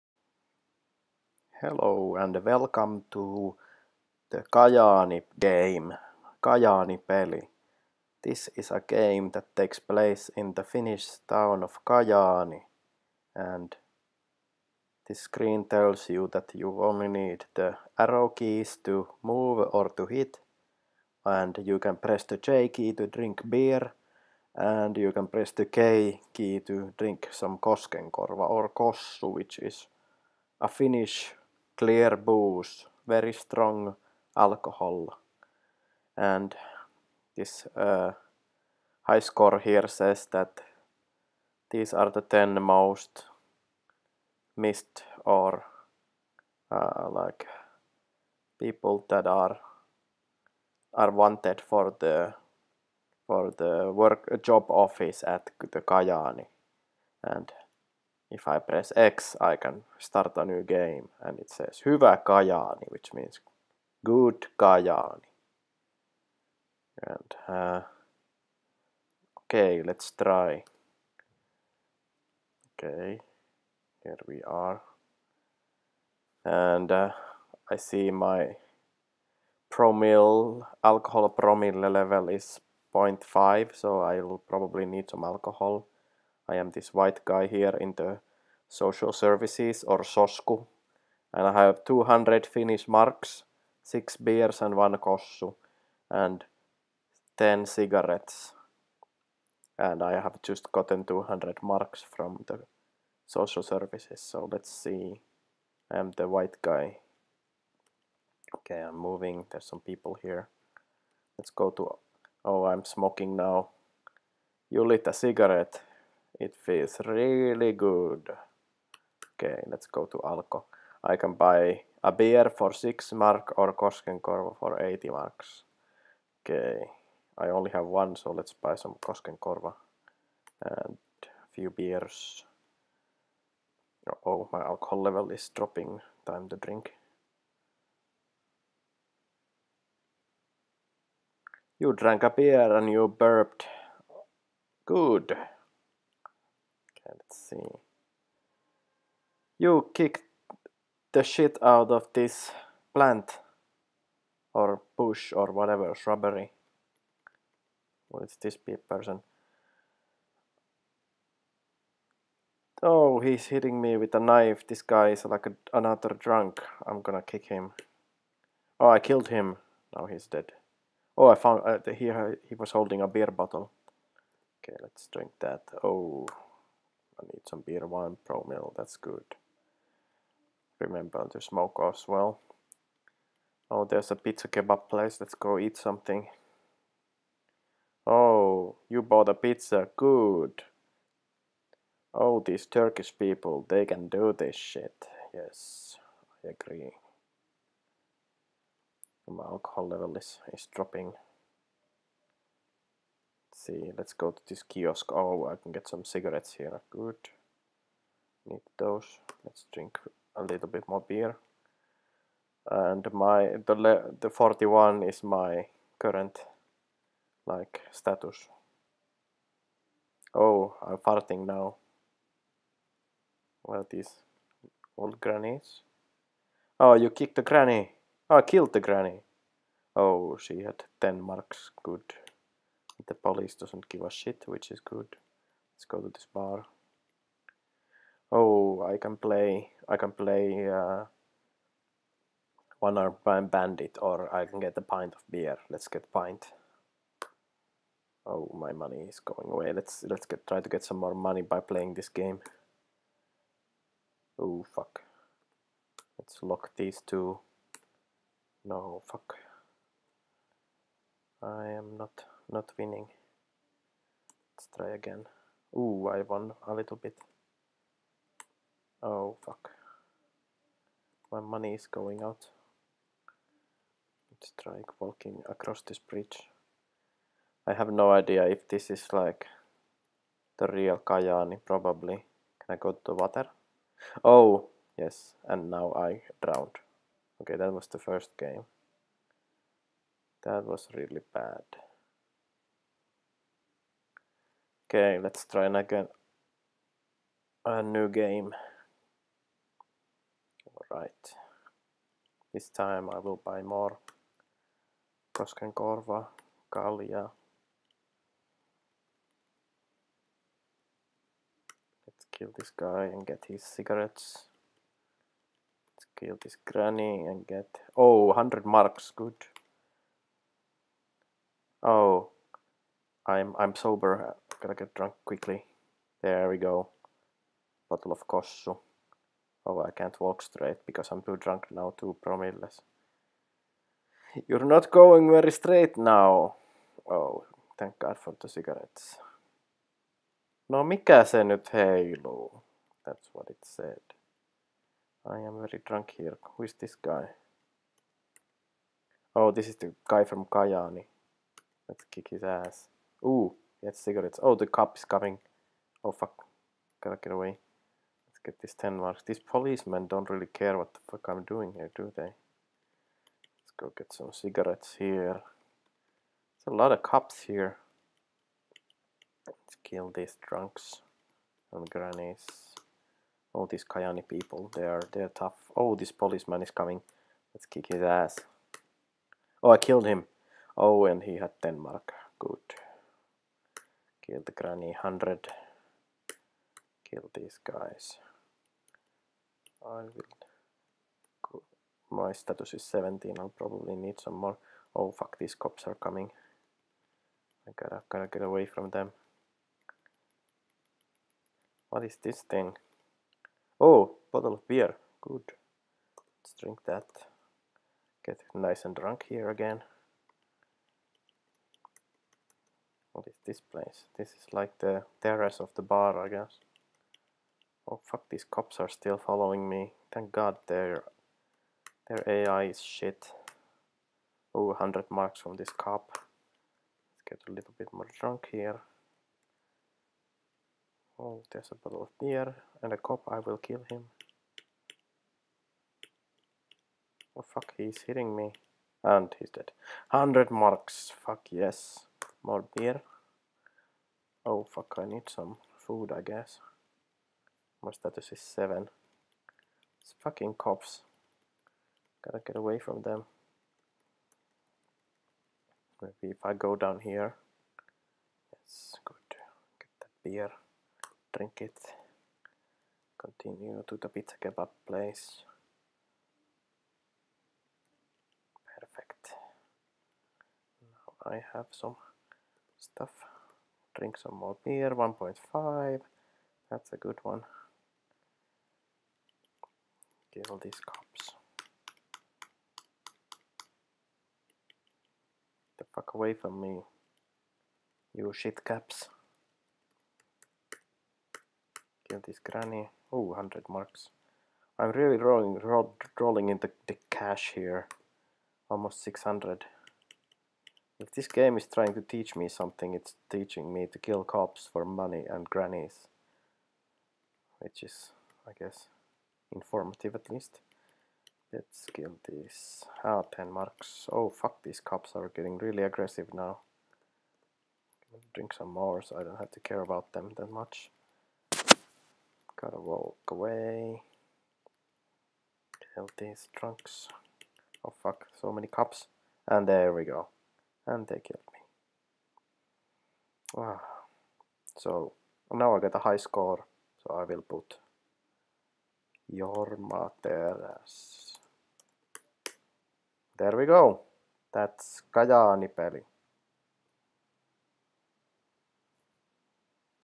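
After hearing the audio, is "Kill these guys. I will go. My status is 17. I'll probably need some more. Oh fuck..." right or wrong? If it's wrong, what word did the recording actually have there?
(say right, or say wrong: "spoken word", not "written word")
right.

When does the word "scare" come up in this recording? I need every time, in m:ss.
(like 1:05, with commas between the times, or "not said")
not said.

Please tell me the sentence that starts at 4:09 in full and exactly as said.
Let's let's get try to get some more money by playing this game.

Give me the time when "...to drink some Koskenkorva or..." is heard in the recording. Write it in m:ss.
0:26.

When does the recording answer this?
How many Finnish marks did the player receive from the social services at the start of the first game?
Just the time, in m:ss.
1:41.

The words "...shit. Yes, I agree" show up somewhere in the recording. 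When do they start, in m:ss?
3:14.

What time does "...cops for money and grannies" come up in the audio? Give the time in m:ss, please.
8:24.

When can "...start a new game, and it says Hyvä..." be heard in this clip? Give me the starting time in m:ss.
0:59.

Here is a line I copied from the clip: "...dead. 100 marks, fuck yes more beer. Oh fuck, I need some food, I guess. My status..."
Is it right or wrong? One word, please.
right.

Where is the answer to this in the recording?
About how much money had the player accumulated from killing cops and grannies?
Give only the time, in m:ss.
8:18.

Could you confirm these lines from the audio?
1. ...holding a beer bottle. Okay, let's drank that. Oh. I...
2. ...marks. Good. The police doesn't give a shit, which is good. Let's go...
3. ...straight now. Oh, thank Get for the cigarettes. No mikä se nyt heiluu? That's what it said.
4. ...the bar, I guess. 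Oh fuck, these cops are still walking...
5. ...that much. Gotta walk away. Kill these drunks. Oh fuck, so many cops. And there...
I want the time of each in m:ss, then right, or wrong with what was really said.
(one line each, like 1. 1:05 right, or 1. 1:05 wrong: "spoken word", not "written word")
1. 2:52 wrong: "drink", not "drank"
2. 3:51 right
3. 5:35 wrong: "God", not "Get"
4. 6:55 wrong: "following", not "walking"
5. 8:40 wrong: "trunks", not "drunks".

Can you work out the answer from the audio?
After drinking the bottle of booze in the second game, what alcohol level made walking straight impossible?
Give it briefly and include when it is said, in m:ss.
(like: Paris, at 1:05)
2 promilles, at 5:31.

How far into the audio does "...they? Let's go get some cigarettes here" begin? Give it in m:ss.
6:02.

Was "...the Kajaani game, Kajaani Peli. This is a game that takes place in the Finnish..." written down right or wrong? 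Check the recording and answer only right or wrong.
right.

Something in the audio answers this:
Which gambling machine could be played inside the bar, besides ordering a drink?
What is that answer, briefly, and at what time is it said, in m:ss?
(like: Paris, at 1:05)
One arm bandit, at 4:02.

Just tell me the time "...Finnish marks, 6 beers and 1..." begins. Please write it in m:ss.
1:32.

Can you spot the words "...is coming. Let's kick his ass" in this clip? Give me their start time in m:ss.
6:16.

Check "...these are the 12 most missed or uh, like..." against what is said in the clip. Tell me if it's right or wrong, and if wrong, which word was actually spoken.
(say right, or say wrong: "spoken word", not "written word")
wrong: "10", not "12".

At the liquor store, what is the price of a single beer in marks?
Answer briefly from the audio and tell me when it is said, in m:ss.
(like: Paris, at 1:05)
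6 marks, at 2:02.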